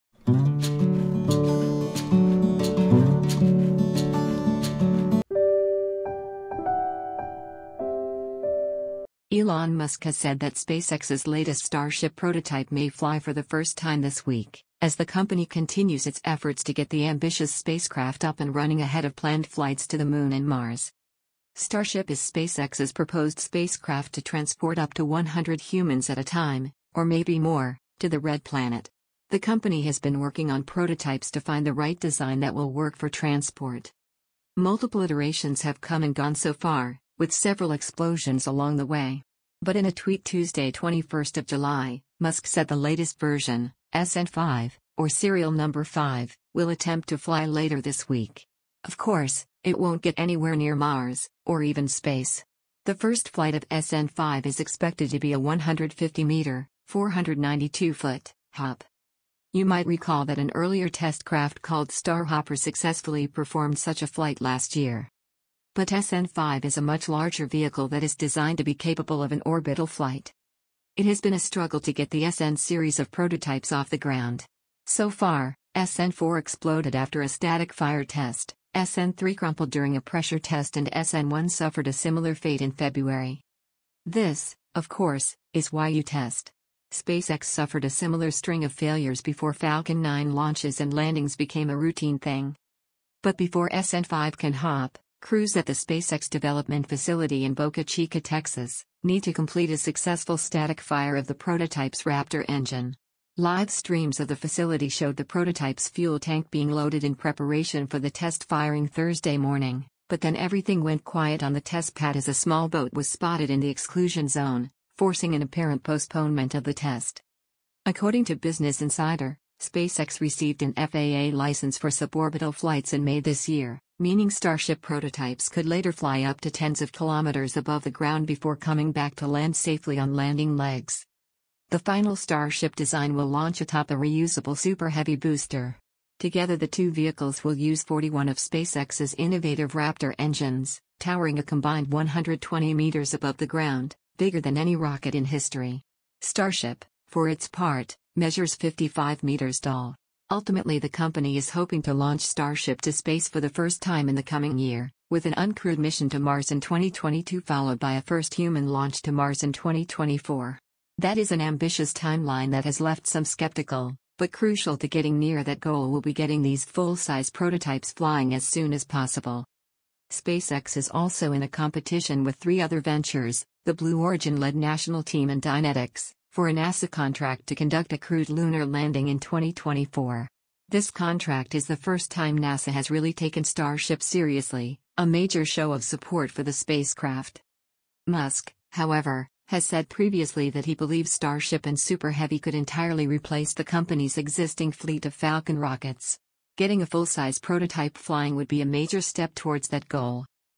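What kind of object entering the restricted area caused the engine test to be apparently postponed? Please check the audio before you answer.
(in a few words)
A small boat.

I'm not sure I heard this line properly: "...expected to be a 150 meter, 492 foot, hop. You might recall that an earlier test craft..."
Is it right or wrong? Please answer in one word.
right.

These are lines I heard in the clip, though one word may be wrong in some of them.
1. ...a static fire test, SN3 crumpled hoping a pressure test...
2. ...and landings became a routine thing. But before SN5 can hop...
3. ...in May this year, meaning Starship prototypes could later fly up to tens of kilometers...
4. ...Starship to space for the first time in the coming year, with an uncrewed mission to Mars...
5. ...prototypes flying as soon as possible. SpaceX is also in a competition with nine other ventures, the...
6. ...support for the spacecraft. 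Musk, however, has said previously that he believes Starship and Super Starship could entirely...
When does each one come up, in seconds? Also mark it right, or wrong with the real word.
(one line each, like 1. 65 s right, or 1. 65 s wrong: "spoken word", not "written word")
1. 77 s wrong: "during", not "hoping"
2. 90 s right
3. 122 s right
4. 152 s right
5. 167 s wrong: "three", not "nine"
6. 185 s wrong: "Heavy", not "Starship".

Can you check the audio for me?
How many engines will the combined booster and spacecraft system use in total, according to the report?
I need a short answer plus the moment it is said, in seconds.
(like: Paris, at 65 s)
41, at 137 s.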